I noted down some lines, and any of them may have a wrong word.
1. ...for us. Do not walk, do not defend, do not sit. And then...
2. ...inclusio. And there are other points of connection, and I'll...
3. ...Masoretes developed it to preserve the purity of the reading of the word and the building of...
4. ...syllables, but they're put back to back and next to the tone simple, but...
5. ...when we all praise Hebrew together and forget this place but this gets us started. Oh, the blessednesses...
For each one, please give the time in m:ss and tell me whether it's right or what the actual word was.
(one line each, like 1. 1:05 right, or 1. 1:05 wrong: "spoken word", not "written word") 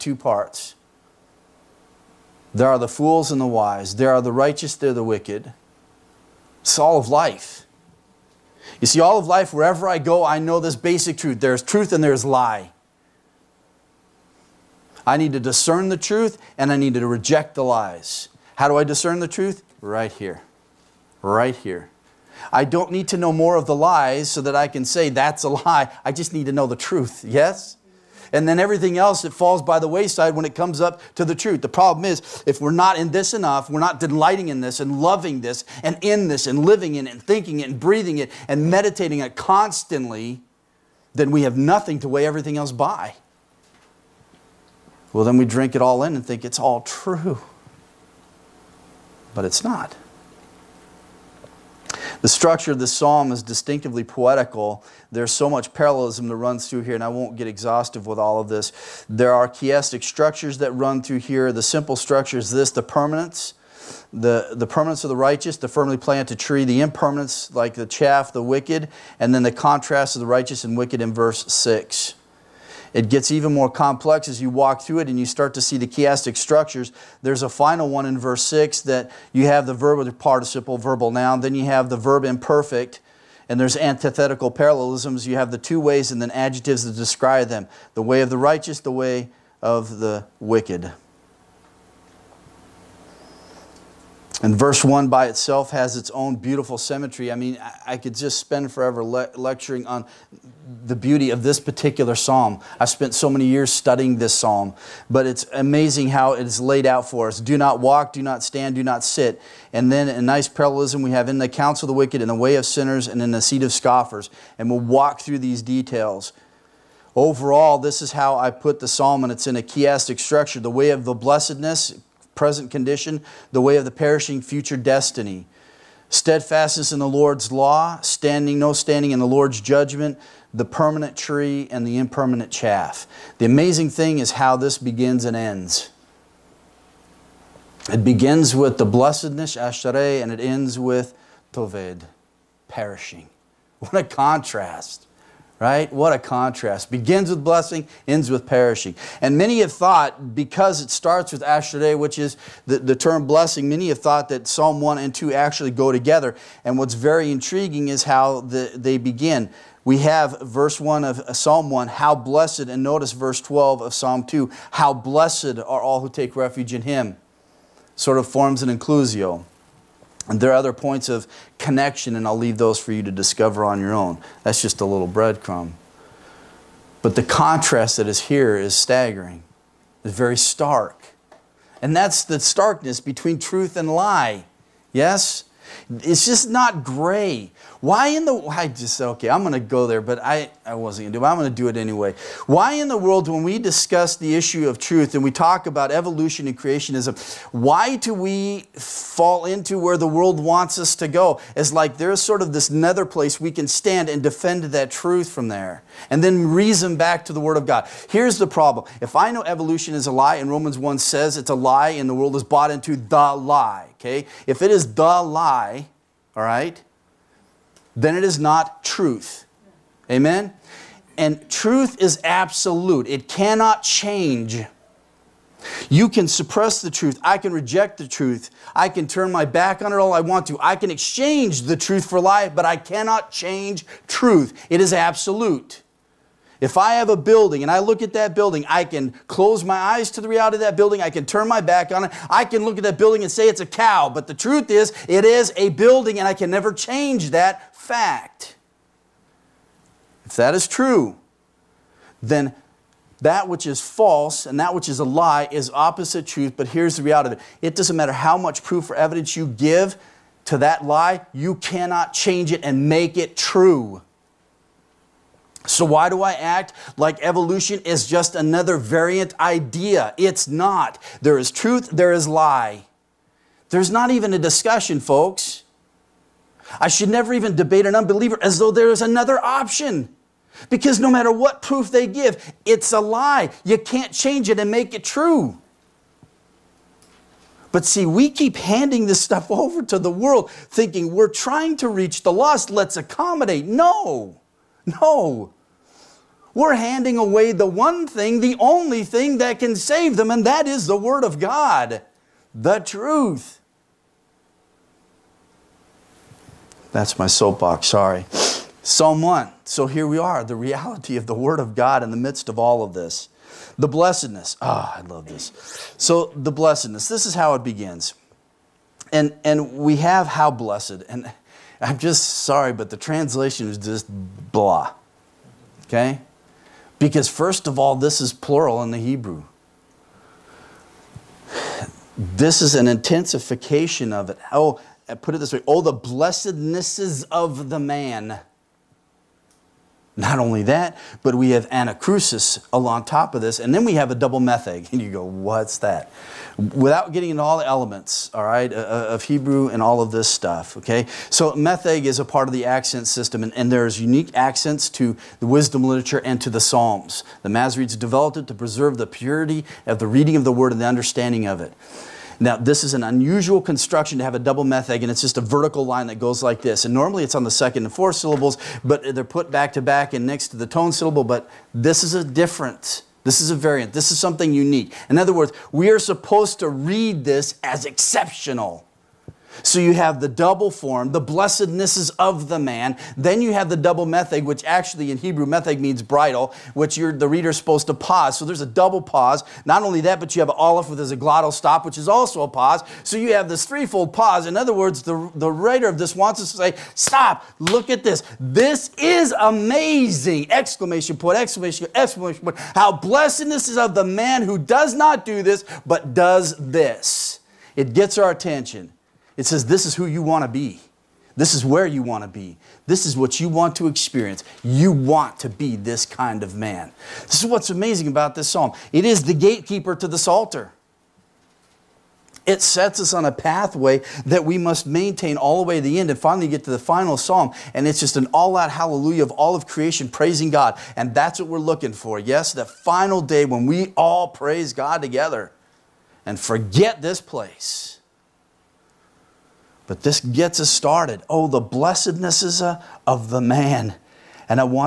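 1. 1:47 wrong: "stand", not "defend"
2. 2:48 right
3. 5:57 wrong: "understanding", not "building"
4. 6:08 wrong: "syllable", not "simple"
5. 7:13 wrong: "God", not "Hebrew".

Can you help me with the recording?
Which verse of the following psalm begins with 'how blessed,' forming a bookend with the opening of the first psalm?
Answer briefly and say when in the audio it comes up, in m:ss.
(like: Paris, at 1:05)
Verse 12, at 2:43.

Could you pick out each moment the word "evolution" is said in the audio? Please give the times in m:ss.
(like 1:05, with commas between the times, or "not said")
3:15, 3:29, 4:27.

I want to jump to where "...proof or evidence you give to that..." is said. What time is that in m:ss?
4:18.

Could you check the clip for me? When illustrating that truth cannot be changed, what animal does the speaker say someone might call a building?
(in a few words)
A cow.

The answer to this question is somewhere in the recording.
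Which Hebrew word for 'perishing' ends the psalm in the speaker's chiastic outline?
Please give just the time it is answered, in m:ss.
2:21.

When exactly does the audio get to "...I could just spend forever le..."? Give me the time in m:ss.
1:37.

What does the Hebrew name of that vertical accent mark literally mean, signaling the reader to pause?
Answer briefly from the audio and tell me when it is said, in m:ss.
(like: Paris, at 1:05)
Bridle, at 6:26.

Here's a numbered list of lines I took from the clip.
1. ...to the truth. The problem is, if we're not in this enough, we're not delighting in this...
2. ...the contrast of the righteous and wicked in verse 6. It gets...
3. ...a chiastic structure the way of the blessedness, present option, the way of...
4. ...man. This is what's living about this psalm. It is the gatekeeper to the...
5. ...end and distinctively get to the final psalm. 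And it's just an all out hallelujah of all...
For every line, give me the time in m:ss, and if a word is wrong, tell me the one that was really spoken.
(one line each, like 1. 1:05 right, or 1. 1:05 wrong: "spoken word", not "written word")
1. 0:31 right
2. 1:09 right
3. 1:59 wrong: "condition", not "option"
4. 6:56 wrong: "amazing", not "living"
5. 7:06 wrong: "finally", not "distinctively".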